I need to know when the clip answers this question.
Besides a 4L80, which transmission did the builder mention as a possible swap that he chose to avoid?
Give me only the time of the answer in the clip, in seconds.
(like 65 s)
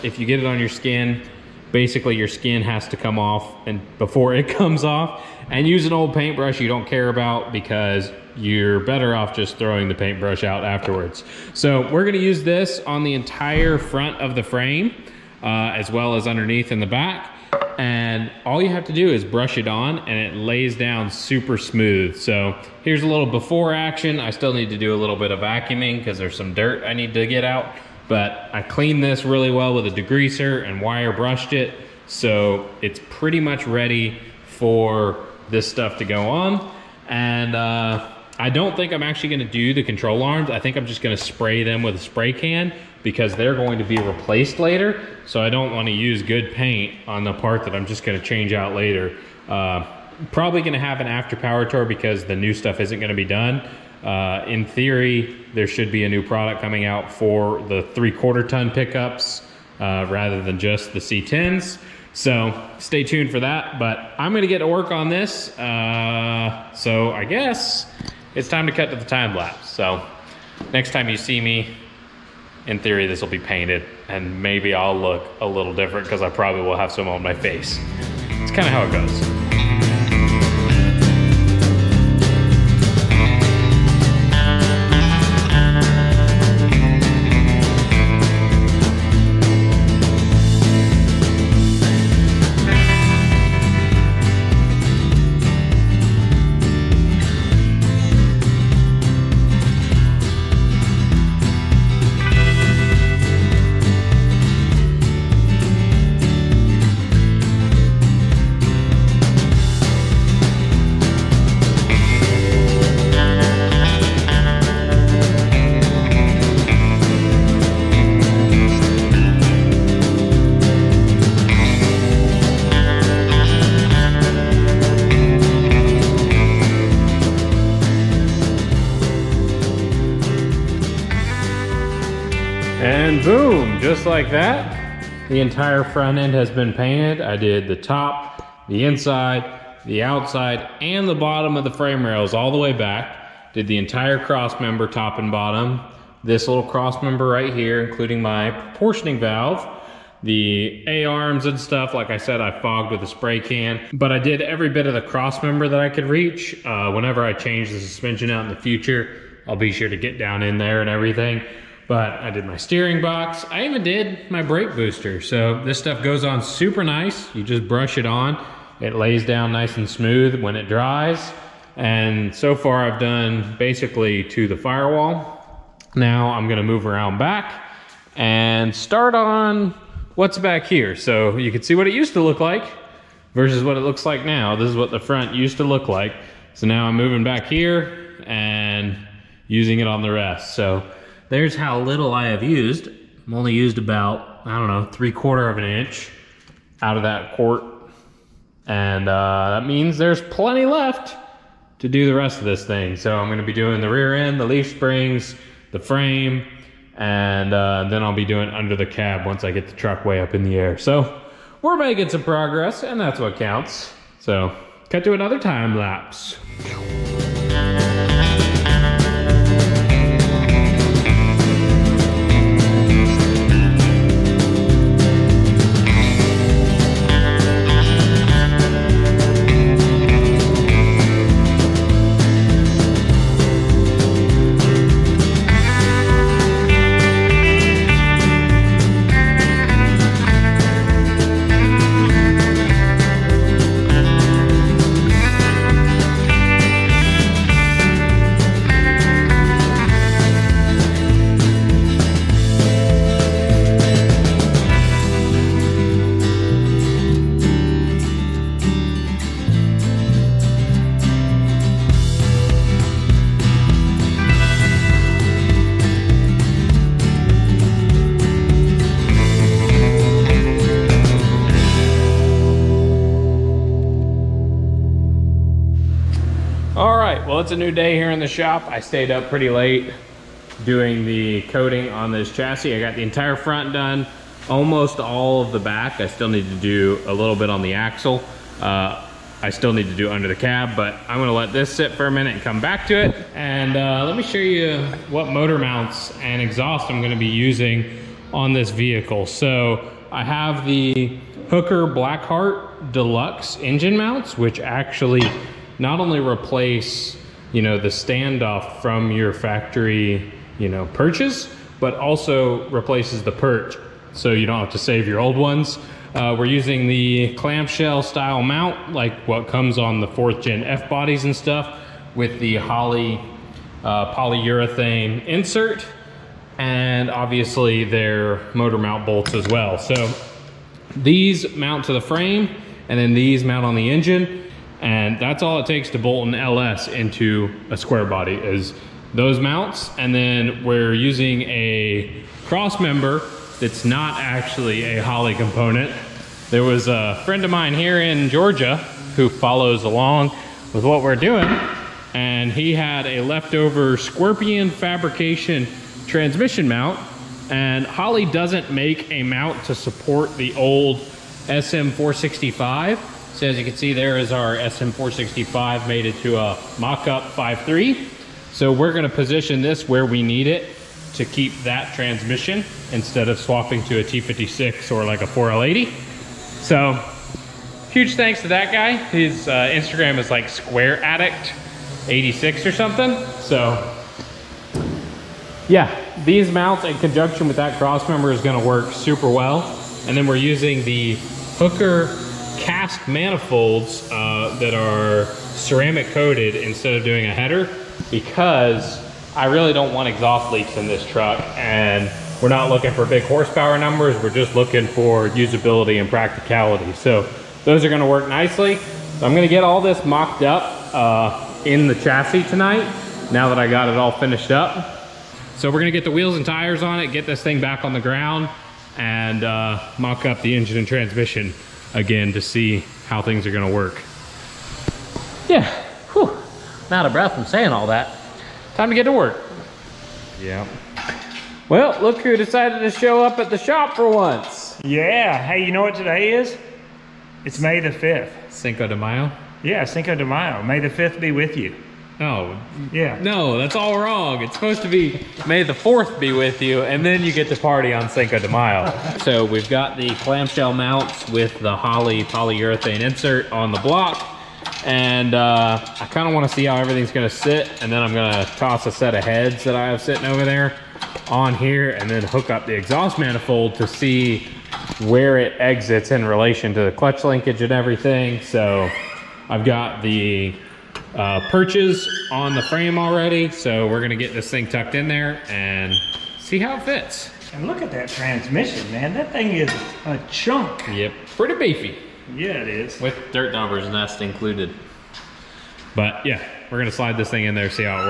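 374 s.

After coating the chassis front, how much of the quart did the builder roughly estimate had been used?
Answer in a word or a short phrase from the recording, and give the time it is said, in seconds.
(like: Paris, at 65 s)
3/4 of an inch, at 194 s.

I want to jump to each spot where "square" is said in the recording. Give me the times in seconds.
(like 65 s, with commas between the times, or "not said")
337 s, 380 s.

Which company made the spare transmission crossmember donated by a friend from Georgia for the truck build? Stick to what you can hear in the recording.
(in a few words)
Scorpion fabrication.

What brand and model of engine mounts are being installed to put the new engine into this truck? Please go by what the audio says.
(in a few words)
Hooker Blackheart Deluxe.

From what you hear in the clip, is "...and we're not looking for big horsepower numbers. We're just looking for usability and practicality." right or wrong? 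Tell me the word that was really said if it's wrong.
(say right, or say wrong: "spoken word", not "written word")
right.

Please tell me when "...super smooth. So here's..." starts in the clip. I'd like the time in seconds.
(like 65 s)
21 s.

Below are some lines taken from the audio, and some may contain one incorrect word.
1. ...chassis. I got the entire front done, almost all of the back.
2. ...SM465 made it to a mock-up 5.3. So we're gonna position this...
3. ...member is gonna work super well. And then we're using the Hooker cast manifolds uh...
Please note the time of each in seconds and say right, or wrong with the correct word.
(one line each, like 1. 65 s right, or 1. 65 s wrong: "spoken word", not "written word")
1. 282 s right
2. 364 s right
3. 388 s right.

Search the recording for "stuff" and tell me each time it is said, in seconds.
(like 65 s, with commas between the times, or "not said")
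35 s, 52 s, 151 s, 165 s, 321 s.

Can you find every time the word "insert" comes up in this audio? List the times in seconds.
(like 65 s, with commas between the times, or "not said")
325 s, 452 s.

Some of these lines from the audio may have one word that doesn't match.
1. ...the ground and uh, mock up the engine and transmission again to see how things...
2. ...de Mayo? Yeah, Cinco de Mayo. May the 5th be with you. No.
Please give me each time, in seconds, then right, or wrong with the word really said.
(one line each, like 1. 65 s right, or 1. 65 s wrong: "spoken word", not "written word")
1. 417 s right
2. 438 s right.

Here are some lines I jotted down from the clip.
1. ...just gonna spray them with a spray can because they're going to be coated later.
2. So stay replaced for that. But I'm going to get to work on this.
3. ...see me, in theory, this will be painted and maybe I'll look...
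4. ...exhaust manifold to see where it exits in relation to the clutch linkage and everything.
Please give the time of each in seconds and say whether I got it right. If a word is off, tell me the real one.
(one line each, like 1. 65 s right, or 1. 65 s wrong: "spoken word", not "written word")
1. 40 s wrong: "replaced", not "coated"
2. 62 s wrong: "tuned", not "replaced"
3. 71 s right
4. 462 s right.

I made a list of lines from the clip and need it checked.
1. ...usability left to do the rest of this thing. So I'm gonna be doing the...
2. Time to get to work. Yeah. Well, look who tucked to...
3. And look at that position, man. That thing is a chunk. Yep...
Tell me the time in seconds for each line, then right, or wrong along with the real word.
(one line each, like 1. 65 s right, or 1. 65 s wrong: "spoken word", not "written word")
1. 200 s wrong: "plenty", not "usability"
2. 428 s wrong: "decided", not "tucked"
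3. 477 s wrong: "transmission", not "position".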